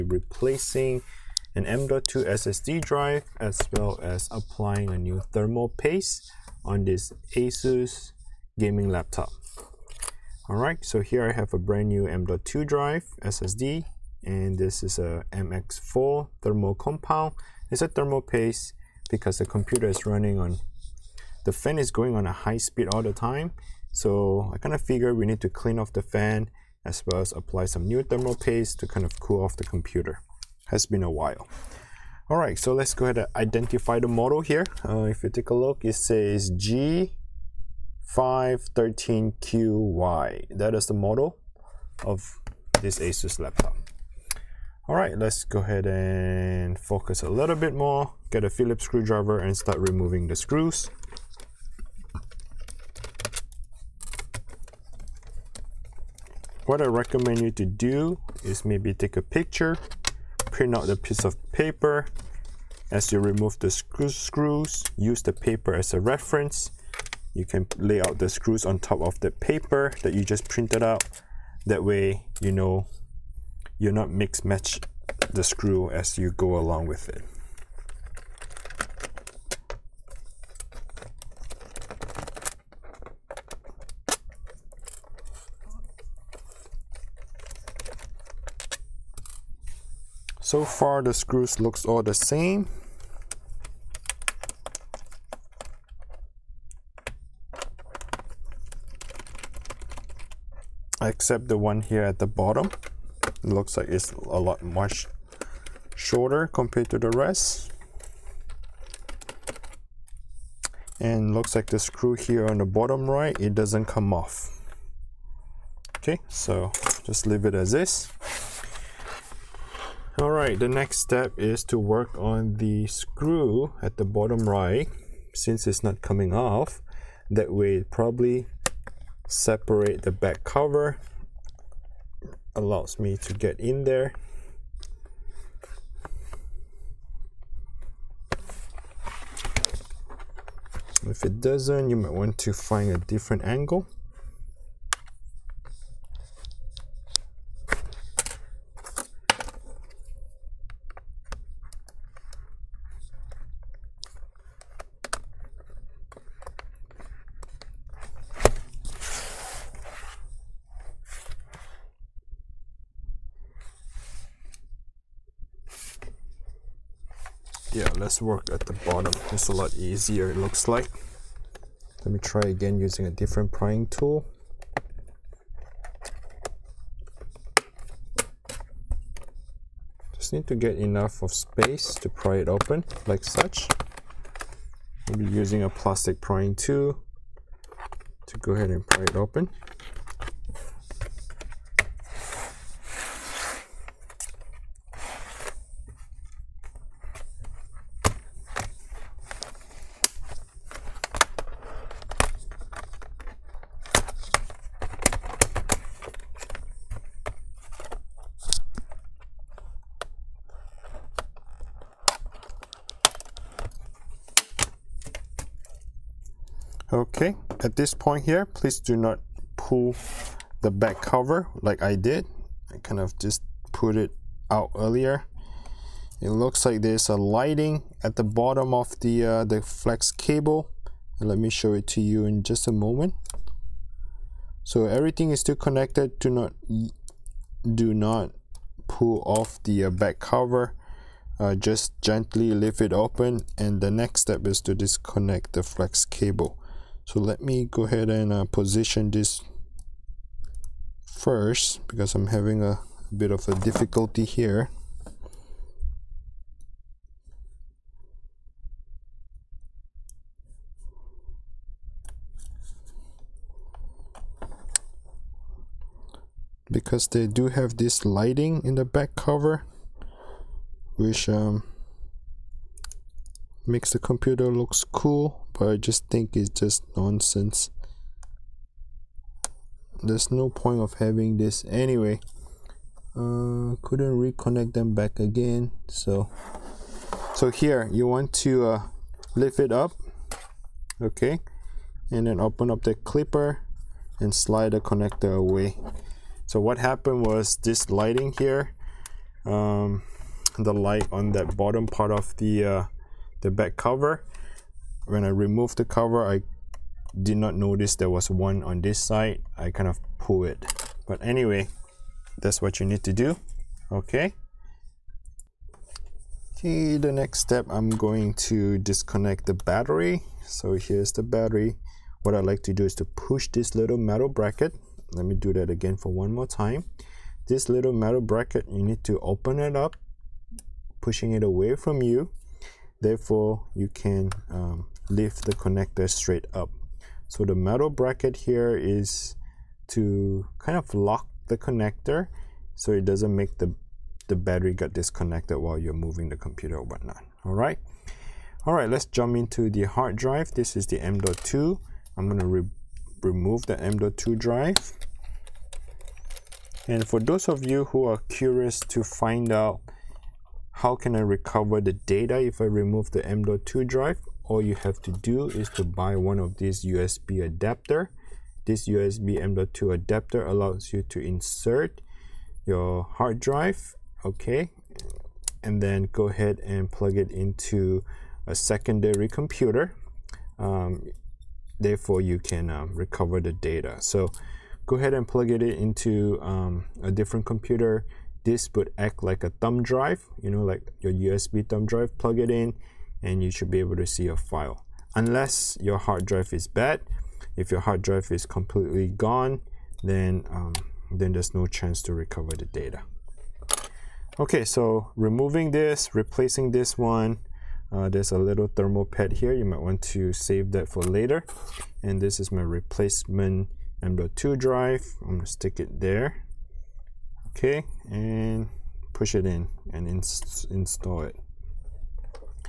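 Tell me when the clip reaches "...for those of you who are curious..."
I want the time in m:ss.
5:57.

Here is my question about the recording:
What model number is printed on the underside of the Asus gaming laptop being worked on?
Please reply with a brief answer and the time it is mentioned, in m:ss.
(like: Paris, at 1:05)
G513QY, at 0:36.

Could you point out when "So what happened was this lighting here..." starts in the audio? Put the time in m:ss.
4:56.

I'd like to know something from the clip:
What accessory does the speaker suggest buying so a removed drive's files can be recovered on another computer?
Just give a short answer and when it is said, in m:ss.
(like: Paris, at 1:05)
USB M.2 adapter, at 6:08.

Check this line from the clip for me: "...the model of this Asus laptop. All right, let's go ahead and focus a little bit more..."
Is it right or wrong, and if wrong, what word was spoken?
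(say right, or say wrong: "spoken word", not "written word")
right.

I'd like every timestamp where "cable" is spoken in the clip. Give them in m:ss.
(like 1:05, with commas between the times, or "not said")
3:50, 4:06.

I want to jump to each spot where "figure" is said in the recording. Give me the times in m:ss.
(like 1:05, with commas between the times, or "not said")
0:24.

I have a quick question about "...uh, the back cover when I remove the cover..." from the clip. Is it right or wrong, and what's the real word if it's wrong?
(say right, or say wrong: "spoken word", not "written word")
right.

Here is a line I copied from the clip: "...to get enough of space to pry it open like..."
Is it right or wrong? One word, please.
right.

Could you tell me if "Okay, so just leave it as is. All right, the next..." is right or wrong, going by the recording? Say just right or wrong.
right.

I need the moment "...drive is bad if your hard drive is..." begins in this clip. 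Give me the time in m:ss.
6:36.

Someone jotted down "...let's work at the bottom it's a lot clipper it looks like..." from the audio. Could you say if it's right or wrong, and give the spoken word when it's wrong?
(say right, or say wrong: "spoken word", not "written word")
wrong: "easier", not "clipper".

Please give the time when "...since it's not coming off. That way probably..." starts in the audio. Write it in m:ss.
2:05.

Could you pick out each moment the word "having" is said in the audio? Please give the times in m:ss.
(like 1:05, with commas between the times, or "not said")
4:12, 4:40.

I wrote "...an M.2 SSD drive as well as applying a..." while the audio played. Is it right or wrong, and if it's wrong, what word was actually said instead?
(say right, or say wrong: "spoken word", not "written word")
right.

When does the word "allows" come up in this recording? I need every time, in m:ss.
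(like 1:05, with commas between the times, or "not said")
2:12, 6:10.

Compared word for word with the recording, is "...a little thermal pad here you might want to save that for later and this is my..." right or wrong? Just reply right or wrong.
right.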